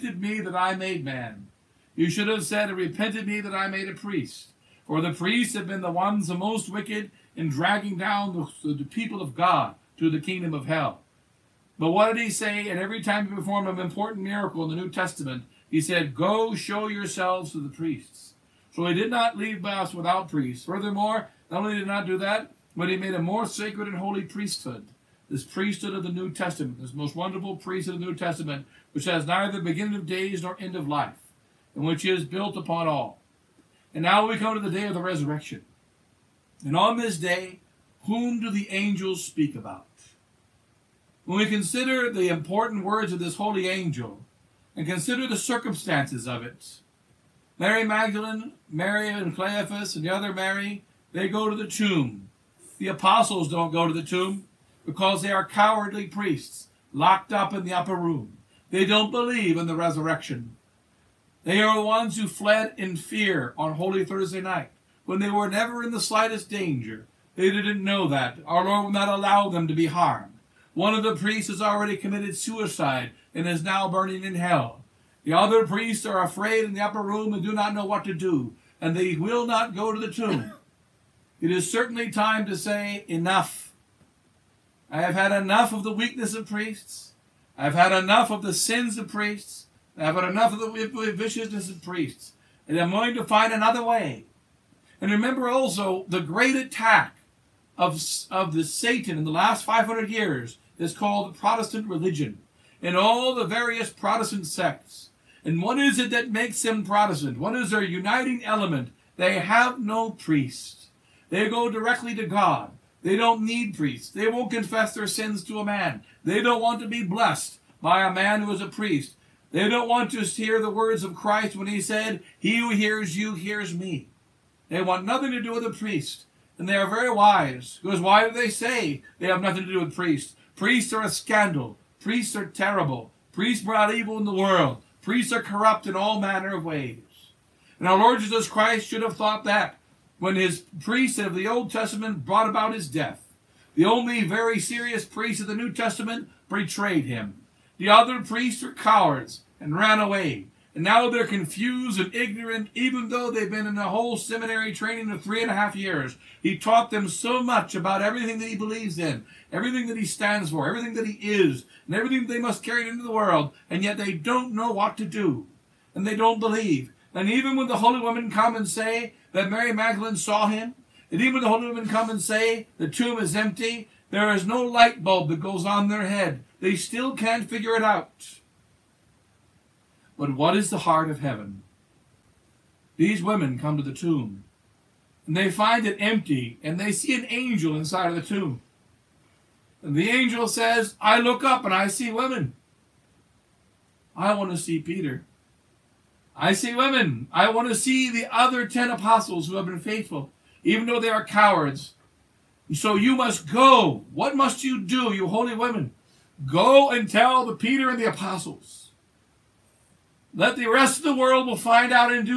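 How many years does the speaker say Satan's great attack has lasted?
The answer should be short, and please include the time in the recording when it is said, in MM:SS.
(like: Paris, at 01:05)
500, at 01:39.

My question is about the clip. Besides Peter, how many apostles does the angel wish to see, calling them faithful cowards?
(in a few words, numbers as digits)
10.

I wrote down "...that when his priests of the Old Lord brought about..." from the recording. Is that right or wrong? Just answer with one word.
wrong.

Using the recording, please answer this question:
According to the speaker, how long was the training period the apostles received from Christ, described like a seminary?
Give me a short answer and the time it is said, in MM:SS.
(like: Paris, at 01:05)
3 and a half years, at 02:35.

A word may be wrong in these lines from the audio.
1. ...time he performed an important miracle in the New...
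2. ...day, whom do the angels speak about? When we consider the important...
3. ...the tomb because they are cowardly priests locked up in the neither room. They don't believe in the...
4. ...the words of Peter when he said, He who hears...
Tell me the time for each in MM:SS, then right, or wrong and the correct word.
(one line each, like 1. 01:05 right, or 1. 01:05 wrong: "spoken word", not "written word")
1. 00:13 right
2. 00:37 right
3. 00:53 wrong: "upper", not "neither"
4. 02:00 wrong: "Christ", not "Peter".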